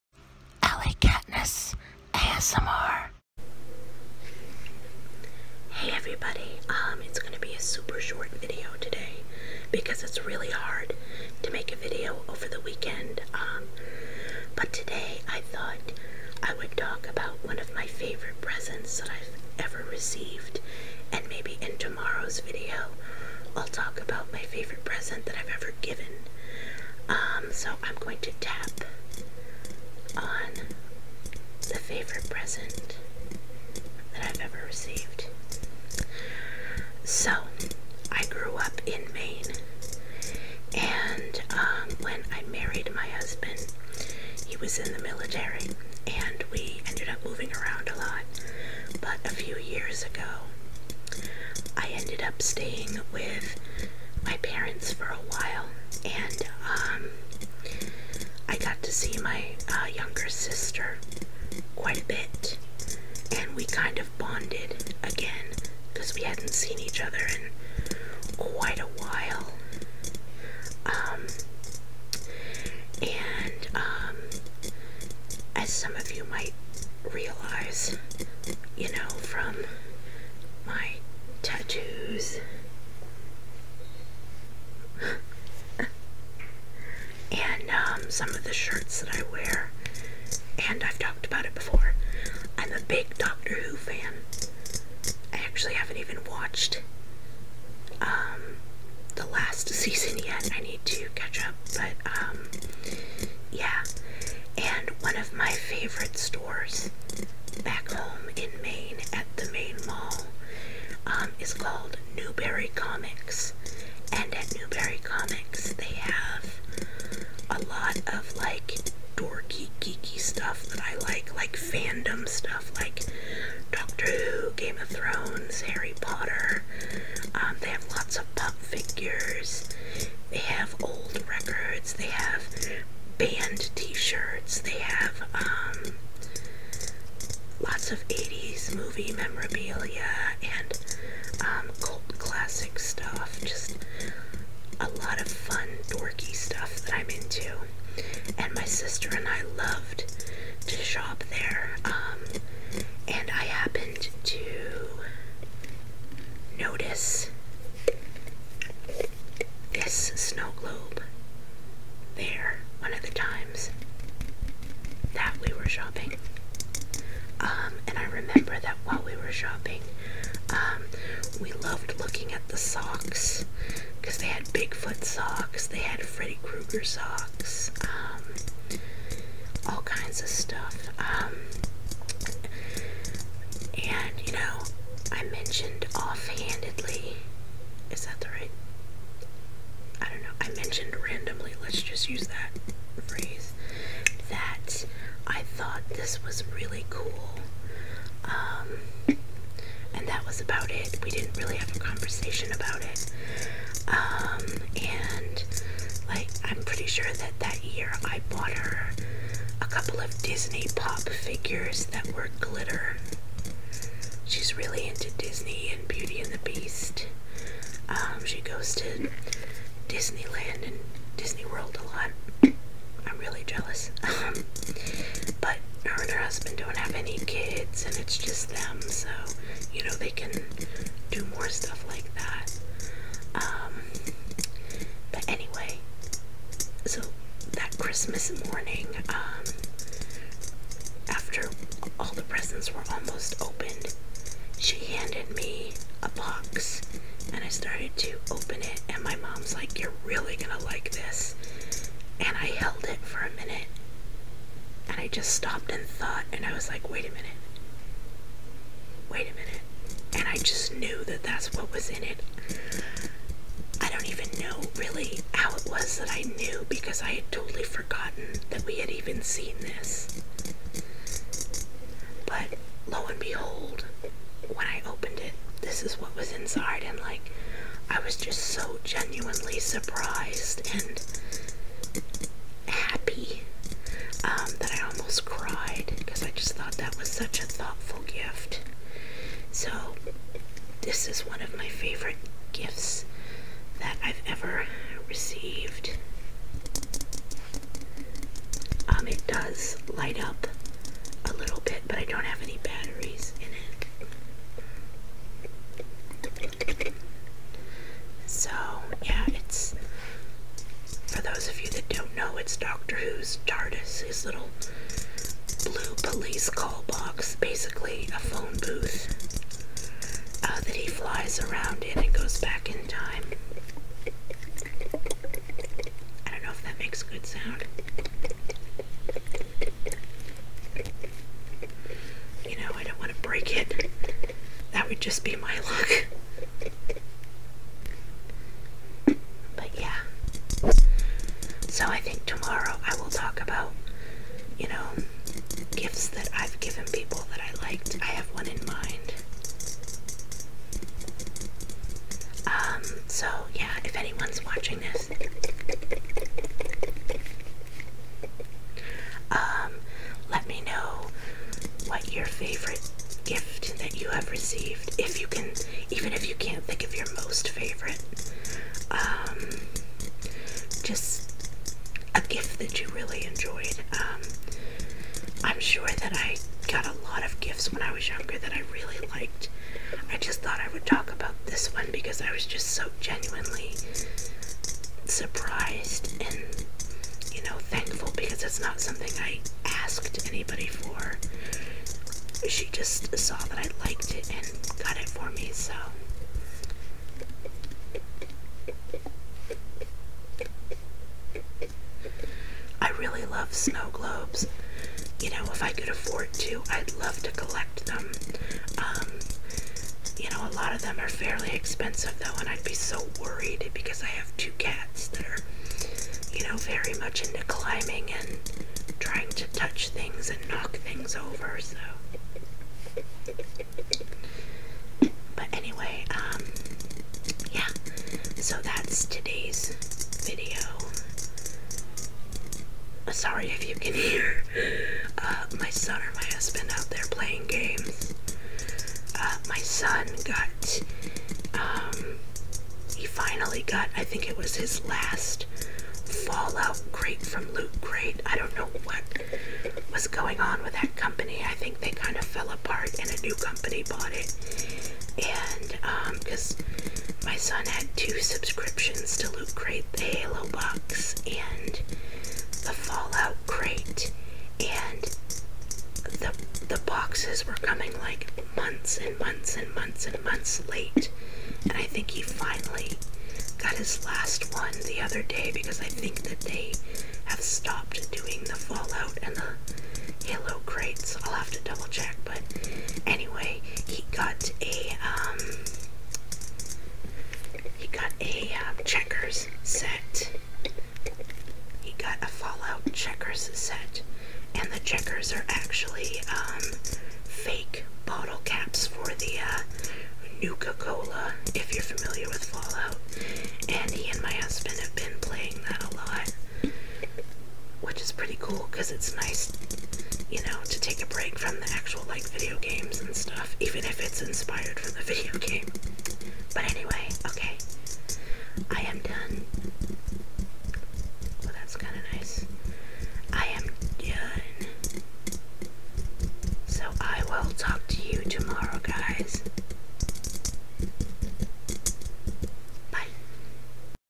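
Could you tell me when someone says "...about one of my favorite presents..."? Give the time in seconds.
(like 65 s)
17 s.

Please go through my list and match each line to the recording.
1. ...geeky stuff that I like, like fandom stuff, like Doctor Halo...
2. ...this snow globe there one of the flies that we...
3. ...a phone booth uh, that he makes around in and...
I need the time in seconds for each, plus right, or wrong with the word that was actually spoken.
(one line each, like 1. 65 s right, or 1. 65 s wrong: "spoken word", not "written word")
1. 119 s wrong: "Who", not "Halo"
2. 159 s wrong: "times", not "flies"
3. 318 s wrong: "flies", not "makes".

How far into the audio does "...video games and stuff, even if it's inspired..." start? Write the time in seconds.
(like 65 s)
512 s.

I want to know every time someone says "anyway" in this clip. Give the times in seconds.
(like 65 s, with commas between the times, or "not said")
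425 s, 483 s, 516 s.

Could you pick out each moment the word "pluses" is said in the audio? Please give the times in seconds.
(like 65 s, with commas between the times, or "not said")
not said.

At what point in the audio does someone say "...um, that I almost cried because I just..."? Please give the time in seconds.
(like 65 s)
284 s.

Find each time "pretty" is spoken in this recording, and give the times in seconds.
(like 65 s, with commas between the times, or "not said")
206 s, 508 s.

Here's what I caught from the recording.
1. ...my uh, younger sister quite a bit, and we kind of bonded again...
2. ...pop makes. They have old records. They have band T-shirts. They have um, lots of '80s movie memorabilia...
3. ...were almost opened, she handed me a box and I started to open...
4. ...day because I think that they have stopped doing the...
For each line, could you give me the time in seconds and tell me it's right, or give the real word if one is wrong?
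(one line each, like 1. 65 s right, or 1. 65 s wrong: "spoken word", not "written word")
1. 59 s right
2. 128 s wrong: "figures", not "makes"
3. 242 s right
4. 475 s right.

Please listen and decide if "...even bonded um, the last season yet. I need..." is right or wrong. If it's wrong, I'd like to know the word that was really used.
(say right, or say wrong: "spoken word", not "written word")
wrong: "watched", not "bonded".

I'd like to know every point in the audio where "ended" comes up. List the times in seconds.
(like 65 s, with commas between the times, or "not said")
46 s, 51 s.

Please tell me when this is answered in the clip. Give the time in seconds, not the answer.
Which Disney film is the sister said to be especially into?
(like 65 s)
215 s.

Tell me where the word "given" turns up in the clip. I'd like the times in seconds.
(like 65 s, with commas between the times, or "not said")
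25 s, 346 s.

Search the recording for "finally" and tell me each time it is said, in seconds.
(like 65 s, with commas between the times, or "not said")
443 s, 472 s.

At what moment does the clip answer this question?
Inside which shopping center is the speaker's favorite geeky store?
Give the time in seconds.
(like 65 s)
109 s.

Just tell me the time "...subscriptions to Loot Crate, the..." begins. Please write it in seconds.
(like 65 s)
458 s.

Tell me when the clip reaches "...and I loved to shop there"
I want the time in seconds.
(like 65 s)
149 s.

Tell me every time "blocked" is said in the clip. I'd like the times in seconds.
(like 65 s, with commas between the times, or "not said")
not said.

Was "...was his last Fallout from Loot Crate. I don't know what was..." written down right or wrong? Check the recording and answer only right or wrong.
right.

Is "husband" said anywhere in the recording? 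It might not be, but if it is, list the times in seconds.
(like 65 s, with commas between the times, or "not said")
43 s, 226 s, 436 s, 504 s.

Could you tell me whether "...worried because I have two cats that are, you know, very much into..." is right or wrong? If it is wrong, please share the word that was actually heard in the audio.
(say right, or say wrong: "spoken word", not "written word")
right.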